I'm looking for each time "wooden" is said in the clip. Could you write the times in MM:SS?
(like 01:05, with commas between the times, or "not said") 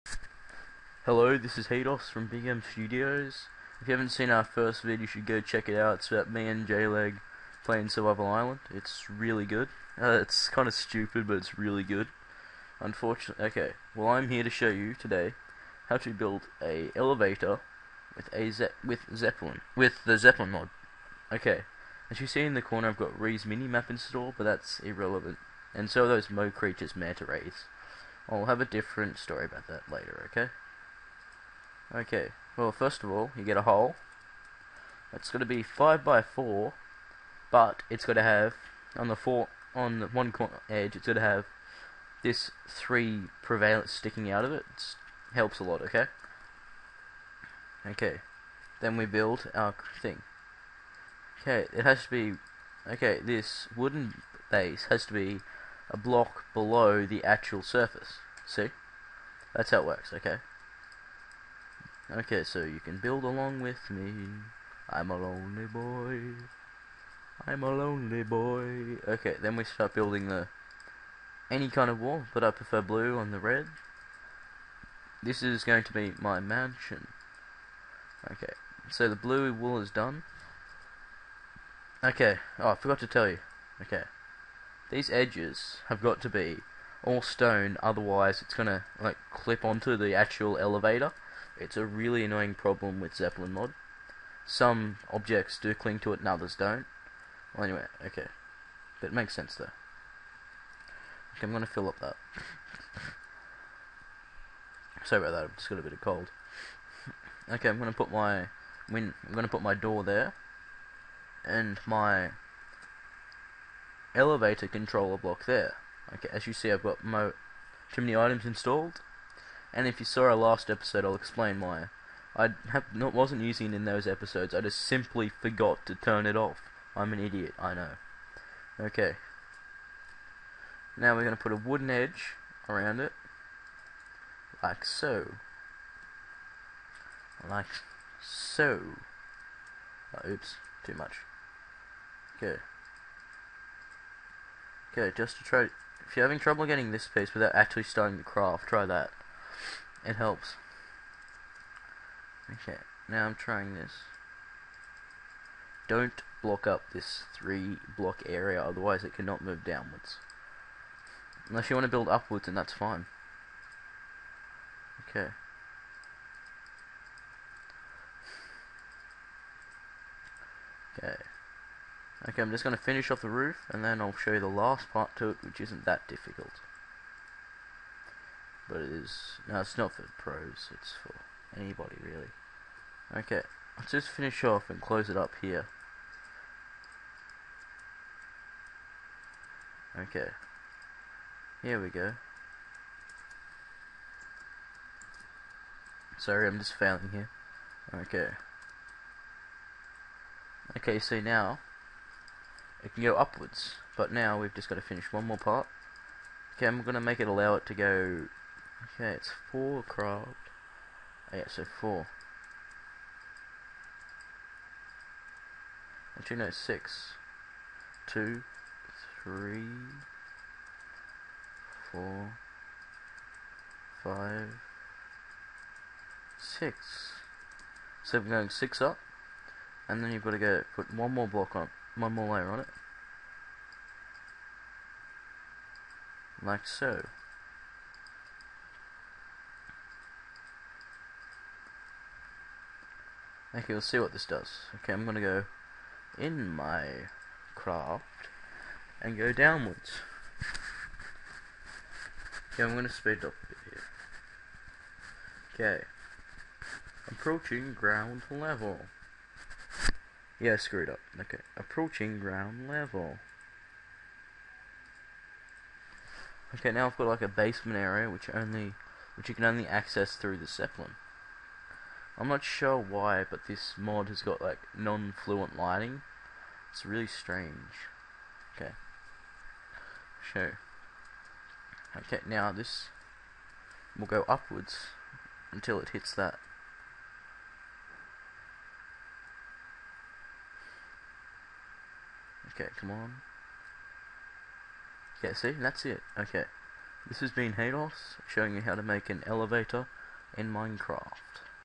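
00:53, 02:11.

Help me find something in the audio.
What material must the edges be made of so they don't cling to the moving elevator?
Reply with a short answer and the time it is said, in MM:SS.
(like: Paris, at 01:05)
Stone, at 01:27.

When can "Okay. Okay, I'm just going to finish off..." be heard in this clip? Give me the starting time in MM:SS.
02:50.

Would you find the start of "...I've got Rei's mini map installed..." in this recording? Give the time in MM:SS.
00:22.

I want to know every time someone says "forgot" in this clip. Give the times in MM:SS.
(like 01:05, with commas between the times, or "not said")
01:22, 02:05.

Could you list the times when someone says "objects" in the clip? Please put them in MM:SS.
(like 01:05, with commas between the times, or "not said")
01:35.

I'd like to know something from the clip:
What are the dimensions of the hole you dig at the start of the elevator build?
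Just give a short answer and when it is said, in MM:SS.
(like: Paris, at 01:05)
5 by 4, at 00:35.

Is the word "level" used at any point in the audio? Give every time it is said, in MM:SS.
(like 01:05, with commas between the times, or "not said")
04:18, 04:22.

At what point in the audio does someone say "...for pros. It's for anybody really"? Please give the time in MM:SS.
02:59.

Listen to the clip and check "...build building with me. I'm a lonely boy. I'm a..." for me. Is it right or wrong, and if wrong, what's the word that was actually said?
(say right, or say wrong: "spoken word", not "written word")
wrong: "along", not "building".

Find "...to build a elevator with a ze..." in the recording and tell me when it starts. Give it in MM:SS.
00:15.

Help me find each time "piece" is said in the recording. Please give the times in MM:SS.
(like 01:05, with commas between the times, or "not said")
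02:27.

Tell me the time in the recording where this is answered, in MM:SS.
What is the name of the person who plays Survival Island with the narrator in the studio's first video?
00:06.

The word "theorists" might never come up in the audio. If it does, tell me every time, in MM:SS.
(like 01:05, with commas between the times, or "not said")
not said.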